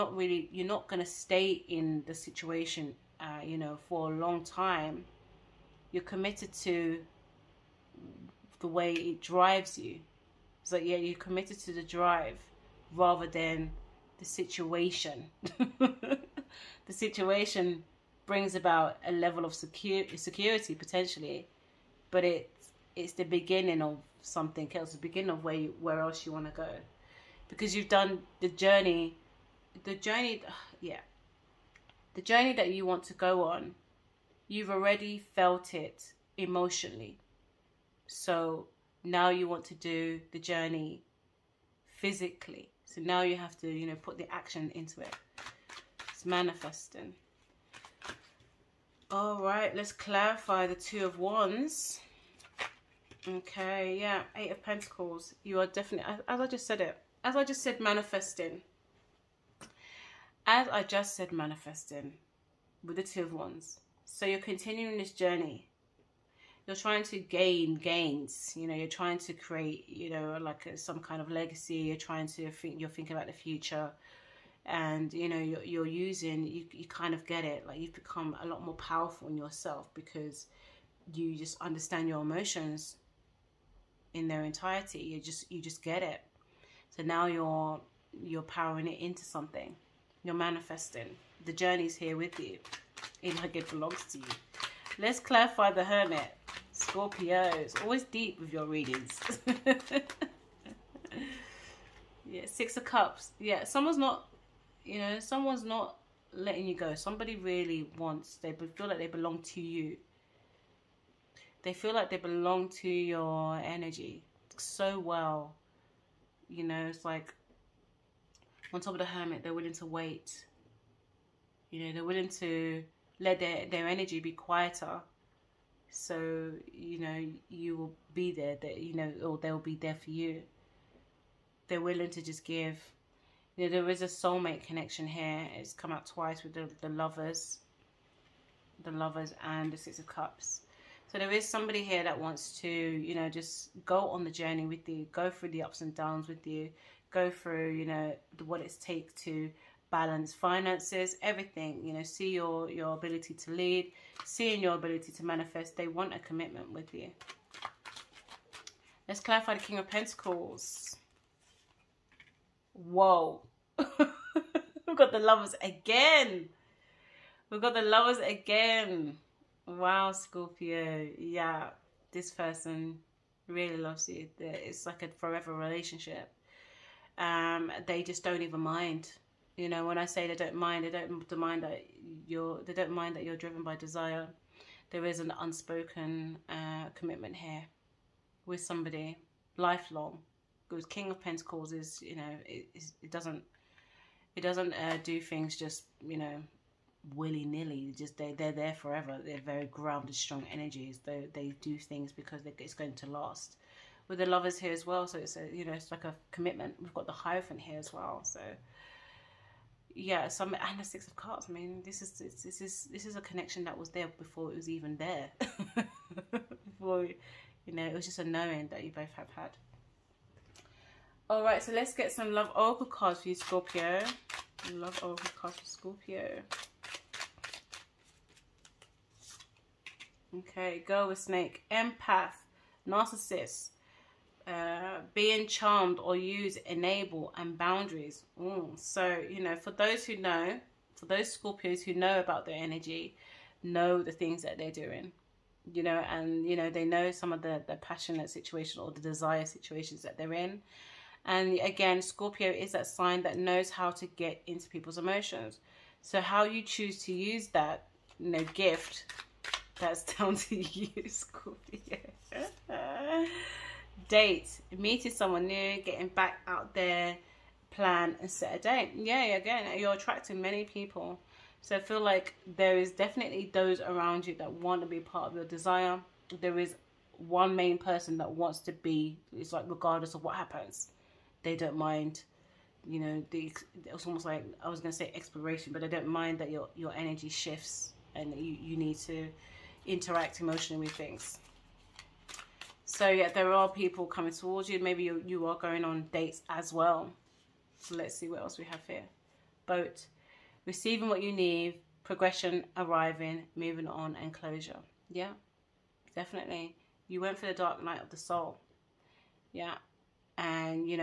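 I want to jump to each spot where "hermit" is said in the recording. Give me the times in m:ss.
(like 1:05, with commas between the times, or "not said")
1:35, 1:59.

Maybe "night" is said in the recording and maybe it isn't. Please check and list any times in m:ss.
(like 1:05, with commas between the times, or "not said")
5:07.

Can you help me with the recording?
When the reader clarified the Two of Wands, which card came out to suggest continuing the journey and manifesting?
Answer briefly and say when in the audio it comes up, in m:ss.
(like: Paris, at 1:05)
Eight of Pentacles, at 0:54.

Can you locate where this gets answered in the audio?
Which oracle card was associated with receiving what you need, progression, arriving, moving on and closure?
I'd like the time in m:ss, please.
4:59.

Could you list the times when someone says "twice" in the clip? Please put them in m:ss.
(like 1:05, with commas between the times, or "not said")
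2:16.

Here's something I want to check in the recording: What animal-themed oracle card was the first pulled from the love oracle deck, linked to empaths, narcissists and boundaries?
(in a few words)
Snake.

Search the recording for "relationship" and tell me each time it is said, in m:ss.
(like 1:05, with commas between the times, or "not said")
2:55.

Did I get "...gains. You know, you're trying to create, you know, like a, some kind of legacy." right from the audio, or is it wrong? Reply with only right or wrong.
right.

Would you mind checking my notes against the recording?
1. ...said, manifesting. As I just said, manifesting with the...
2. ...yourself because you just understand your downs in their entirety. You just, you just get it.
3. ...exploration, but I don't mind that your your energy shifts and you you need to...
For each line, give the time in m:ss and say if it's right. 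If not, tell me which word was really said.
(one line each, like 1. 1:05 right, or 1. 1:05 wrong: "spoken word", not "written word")
1. 0:57 right
2. 1:19 wrong: "emotions", not "downs"
3. 4:45 right.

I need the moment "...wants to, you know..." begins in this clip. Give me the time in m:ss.
2:22.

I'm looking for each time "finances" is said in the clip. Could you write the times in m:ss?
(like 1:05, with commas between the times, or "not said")
2:30.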